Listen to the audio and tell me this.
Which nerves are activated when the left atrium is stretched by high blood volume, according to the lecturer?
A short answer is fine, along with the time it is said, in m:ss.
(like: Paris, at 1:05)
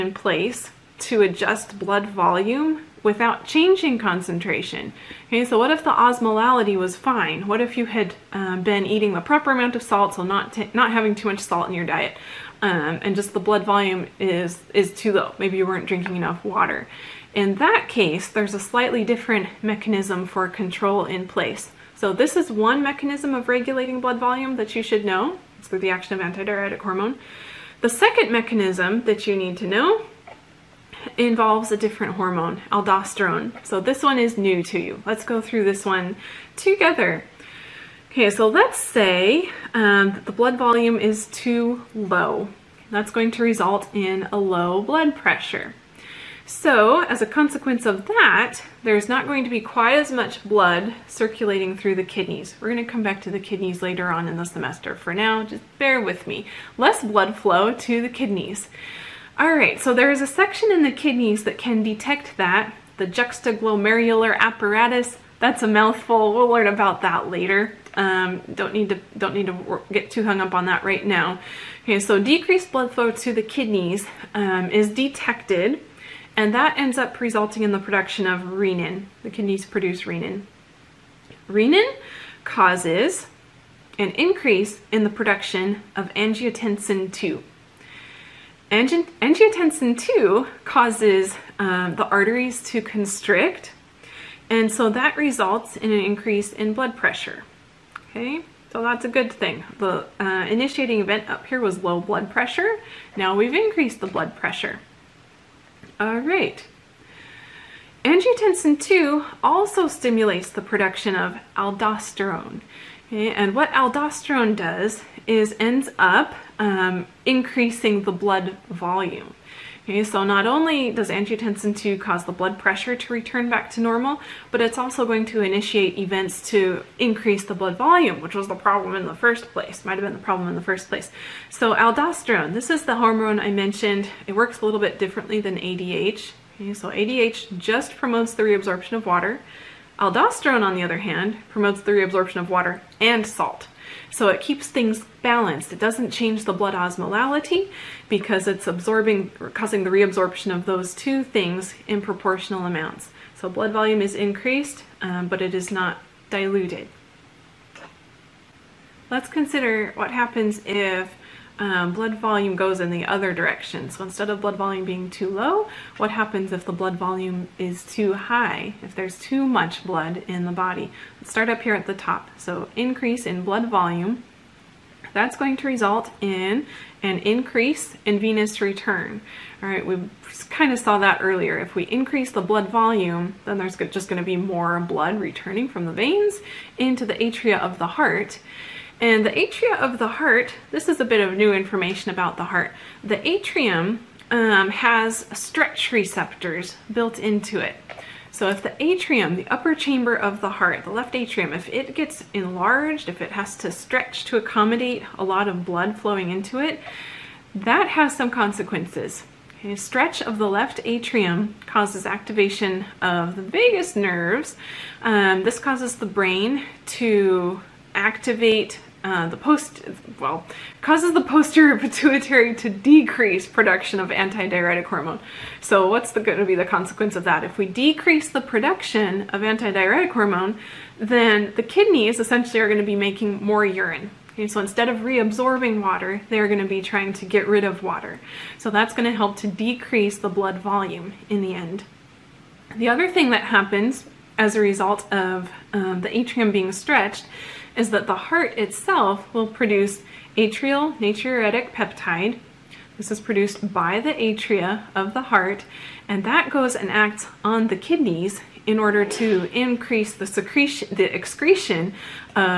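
vagus nerves, at 3:33.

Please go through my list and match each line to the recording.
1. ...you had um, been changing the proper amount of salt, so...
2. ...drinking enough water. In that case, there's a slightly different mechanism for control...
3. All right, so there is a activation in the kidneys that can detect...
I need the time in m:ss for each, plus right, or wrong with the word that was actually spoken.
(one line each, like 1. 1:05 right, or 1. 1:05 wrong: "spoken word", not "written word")
1. 0:07 wrong: "eating", not "changing"
2. 0:15 right
3. 0:59 wrong: "section", not "activation".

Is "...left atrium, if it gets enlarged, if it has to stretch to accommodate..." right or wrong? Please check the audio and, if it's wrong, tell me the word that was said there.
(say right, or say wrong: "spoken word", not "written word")
right.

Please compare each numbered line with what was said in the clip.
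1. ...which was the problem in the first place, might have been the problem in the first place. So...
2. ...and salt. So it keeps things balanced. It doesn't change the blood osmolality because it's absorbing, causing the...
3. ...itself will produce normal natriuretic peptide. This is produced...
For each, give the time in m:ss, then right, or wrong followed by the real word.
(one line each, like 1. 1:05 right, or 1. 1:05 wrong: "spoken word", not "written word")
1. 2:08 right
2. 2:22 right
3. 4:08 wrong: "atrial", not "normal".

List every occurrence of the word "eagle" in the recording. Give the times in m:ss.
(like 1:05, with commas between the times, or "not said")
not said.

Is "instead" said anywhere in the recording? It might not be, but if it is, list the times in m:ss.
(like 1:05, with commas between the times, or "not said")
2:44, 3:54.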